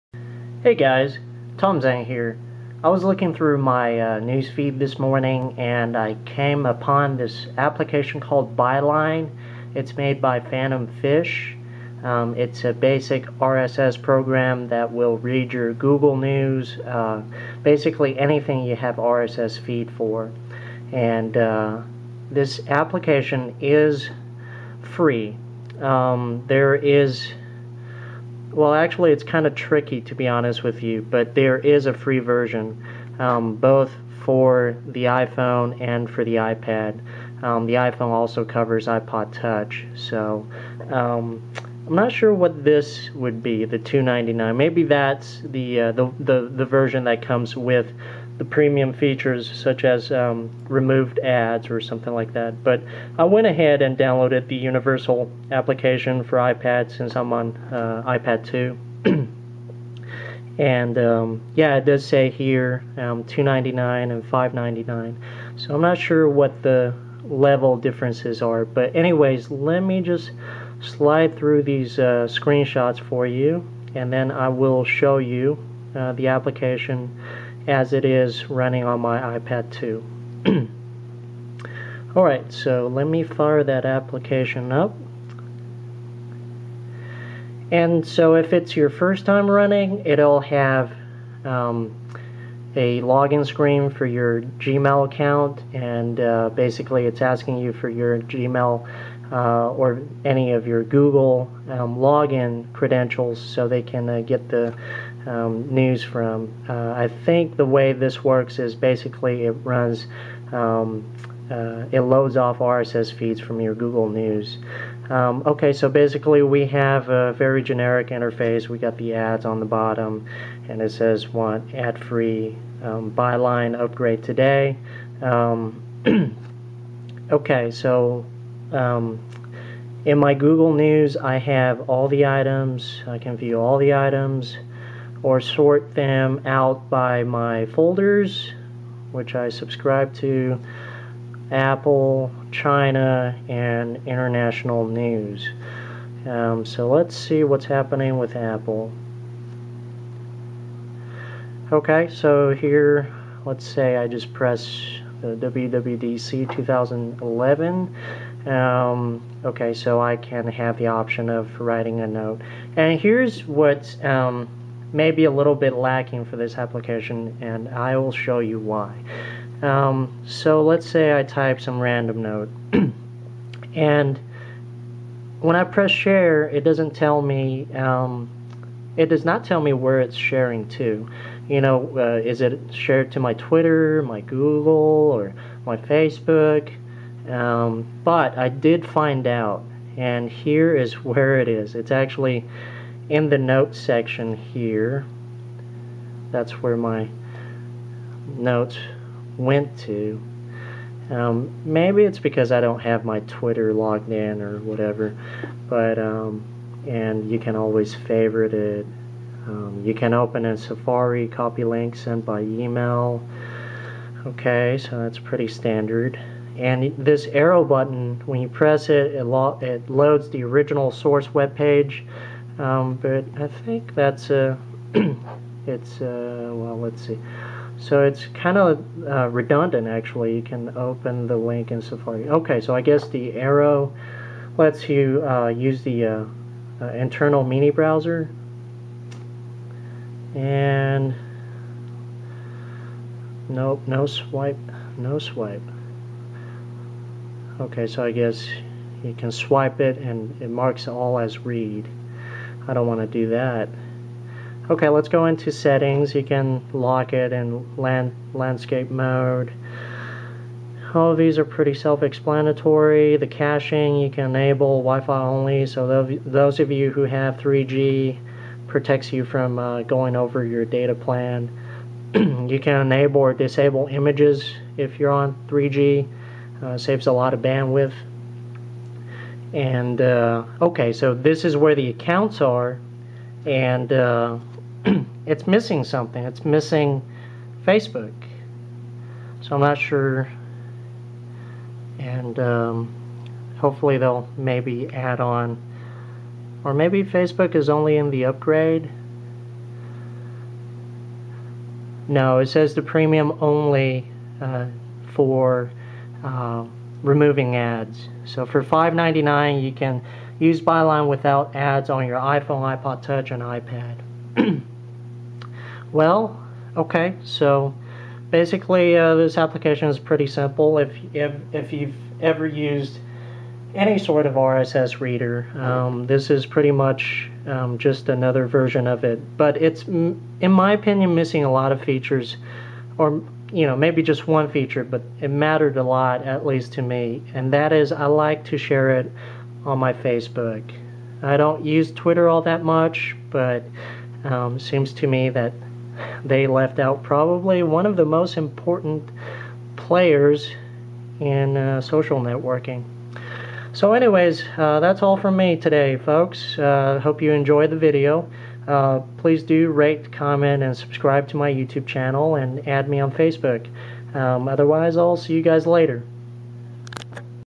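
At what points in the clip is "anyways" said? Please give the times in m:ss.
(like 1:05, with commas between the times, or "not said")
1:08, 5:53.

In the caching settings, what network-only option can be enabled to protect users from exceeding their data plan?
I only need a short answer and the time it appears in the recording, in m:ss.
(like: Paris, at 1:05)
Wi-Fi only, at 4:24.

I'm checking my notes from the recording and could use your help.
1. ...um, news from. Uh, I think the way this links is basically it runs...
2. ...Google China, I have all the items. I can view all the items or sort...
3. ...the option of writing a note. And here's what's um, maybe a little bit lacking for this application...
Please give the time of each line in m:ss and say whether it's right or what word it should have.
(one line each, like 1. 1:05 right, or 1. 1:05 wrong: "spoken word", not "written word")
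1. 1:45 wrong: "works", not "links"
2. 2:10 wrong: "News", not "China"
3. 2:40 right.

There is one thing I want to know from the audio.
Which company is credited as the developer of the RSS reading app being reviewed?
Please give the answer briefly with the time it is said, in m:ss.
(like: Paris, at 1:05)
Phantom Fish, at 0:10.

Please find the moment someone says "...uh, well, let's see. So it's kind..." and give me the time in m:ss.
3:46.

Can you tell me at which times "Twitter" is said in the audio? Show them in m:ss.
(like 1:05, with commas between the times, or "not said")
3:03, 3:23, 5:41.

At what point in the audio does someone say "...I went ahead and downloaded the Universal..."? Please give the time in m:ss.
0:53.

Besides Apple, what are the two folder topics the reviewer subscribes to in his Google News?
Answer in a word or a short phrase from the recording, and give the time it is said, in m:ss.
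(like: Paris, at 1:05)
China and international news, at 2:22.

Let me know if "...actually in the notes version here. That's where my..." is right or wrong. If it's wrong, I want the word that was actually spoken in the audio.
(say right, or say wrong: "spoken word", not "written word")
wrong: "section", not "version".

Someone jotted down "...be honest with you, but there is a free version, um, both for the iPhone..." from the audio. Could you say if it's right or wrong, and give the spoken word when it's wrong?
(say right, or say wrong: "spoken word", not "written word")
right.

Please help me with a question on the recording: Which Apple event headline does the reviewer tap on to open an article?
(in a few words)
WWDC 2011.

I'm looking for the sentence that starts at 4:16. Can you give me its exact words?
You can lock it in land, landscape mode.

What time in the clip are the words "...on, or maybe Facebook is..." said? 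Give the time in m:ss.
4:55.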